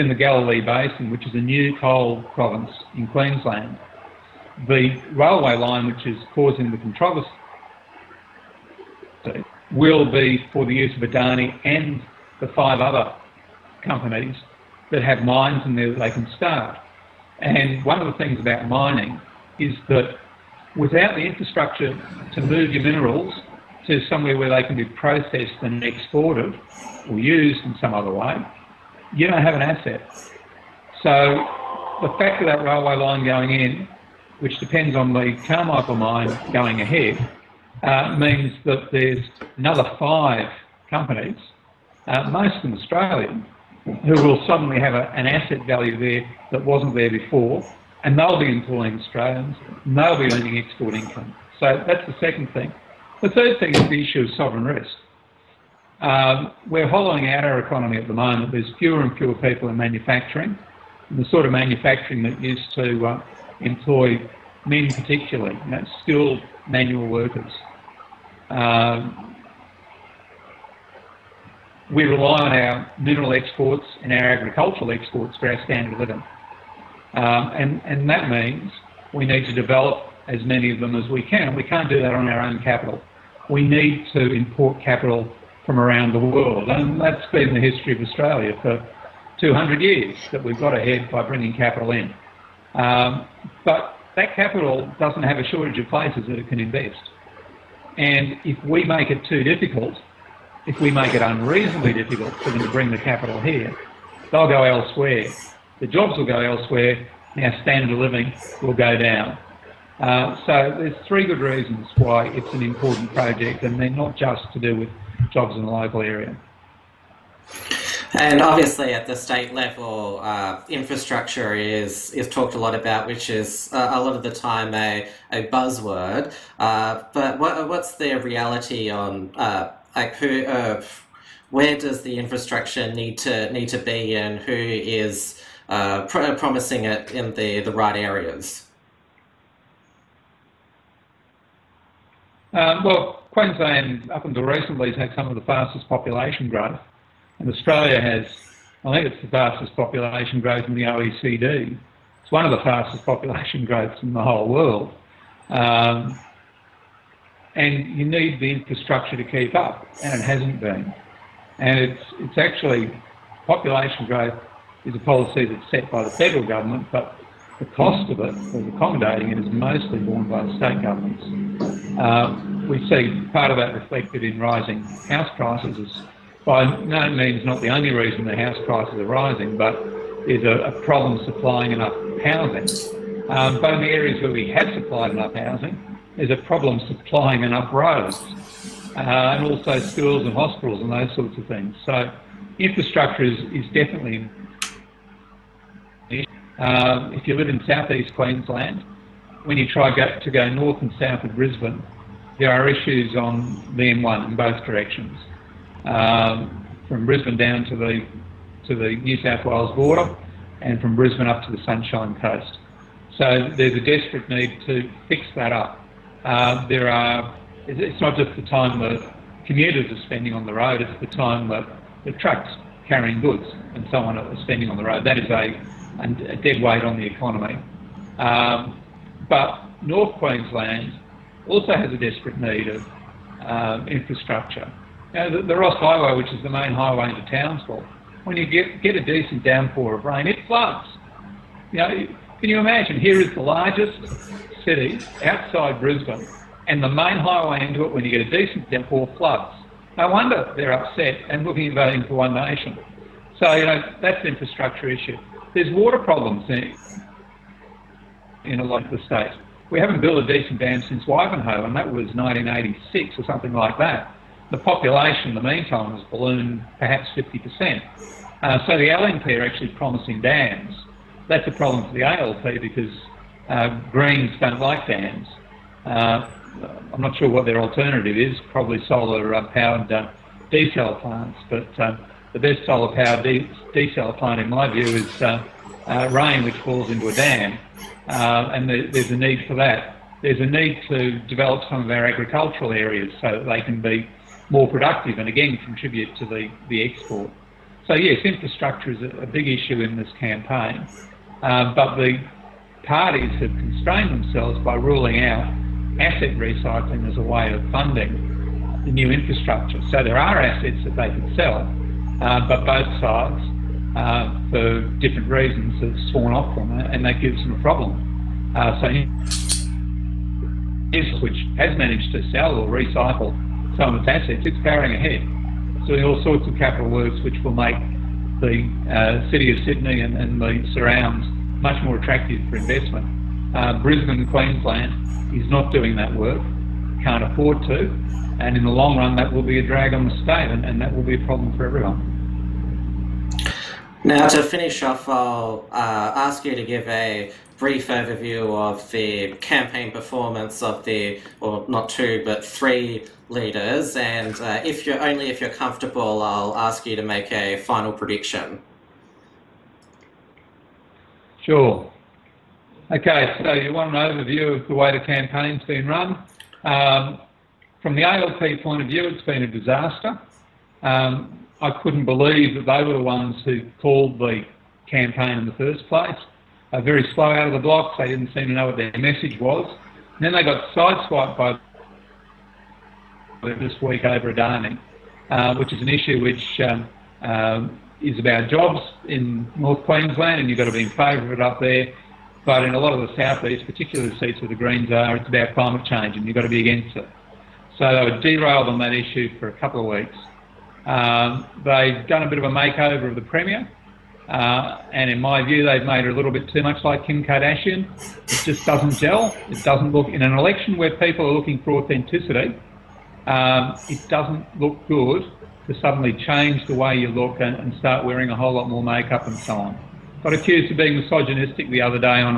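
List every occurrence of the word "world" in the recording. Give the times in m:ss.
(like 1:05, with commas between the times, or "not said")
1:26, 2:34.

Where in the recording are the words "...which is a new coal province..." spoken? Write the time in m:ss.
0:01.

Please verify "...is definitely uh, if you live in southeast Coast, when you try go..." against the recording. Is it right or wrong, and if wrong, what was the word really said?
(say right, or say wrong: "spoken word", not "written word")
wrong: "Queensland", not "Coast".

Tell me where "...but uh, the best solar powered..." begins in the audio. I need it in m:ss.
4:41.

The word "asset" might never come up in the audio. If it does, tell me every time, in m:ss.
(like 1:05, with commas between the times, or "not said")
0:29, 0:45, 5:05, 5:10, 5:24.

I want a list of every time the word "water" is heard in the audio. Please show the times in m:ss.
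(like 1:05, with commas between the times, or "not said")
4:15.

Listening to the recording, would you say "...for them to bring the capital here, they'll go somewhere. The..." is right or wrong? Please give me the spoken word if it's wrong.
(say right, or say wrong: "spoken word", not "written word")
wrong: "elsewhere", not "somewhere".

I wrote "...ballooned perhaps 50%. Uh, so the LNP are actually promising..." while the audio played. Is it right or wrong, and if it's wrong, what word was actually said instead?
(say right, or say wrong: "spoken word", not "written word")
right.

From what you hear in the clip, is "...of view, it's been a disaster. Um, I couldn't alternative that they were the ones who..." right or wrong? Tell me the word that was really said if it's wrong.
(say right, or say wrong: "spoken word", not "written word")
wrong: "believe", not "alternative".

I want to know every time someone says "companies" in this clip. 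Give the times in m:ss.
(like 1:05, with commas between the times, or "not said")
0:13, 0:40.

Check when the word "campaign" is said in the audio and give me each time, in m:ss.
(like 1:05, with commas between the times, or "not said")
5:00, 5:49, 6:05, 6:14.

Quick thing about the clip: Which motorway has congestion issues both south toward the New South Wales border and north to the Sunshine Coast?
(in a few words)
M1.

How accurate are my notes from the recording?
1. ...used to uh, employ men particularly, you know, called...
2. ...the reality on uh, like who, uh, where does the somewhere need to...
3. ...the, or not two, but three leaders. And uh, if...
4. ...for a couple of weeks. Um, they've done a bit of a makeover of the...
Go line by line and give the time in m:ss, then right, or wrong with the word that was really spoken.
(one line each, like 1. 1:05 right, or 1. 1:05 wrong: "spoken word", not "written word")
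1. 1:02 wrong: "skilled", not "called"
2. 2:07 wrong: "infrastructure", not "somewhere"
3. 5:50 right
4. 6:39 right.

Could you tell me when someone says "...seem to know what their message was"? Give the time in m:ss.
6:18.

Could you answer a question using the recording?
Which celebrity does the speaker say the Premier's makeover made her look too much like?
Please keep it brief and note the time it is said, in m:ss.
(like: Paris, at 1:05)
Kim Kardashian, at 6:47.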